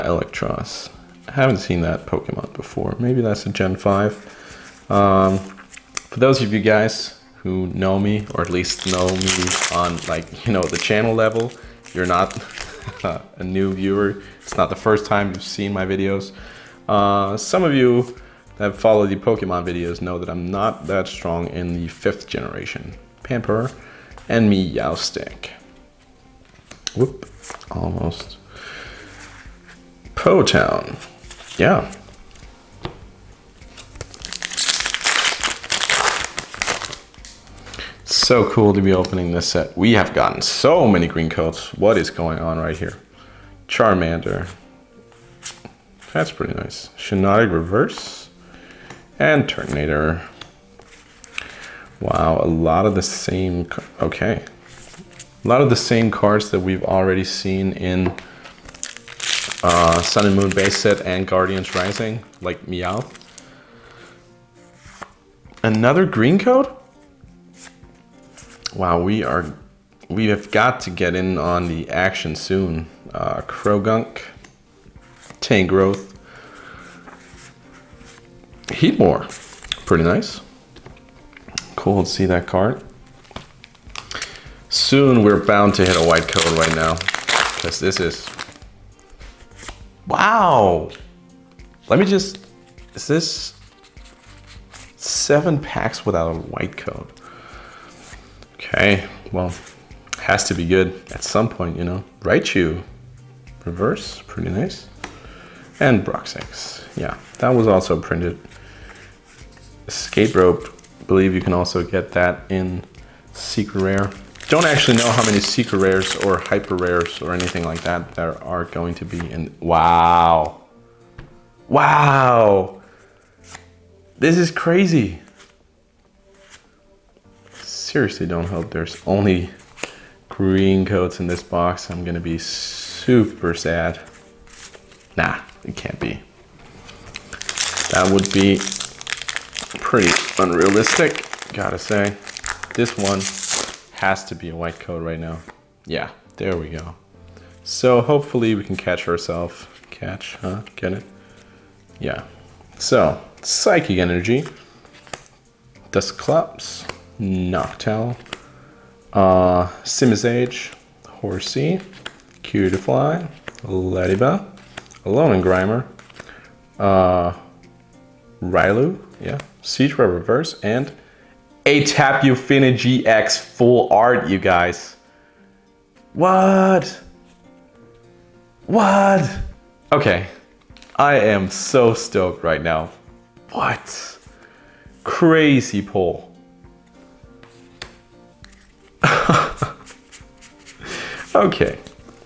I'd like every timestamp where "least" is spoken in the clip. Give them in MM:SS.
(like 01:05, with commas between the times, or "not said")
00:08.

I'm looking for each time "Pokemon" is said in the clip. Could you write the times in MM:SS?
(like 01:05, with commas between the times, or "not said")
00:02, 00:19.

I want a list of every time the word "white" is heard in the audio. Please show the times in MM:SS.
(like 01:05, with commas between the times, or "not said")
01:26, 01:36, 02:24.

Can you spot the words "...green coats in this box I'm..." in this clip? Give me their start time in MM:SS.
02:10.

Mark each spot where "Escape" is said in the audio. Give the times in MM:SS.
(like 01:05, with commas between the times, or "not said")
01:49.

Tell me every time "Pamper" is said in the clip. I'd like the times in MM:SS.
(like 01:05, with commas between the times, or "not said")
00:23.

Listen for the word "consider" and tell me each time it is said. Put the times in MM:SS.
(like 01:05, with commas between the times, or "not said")
not said.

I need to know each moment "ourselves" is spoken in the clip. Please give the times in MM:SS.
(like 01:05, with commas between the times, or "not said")
02:29.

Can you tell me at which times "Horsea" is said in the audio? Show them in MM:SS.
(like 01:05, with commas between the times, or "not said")
02:41.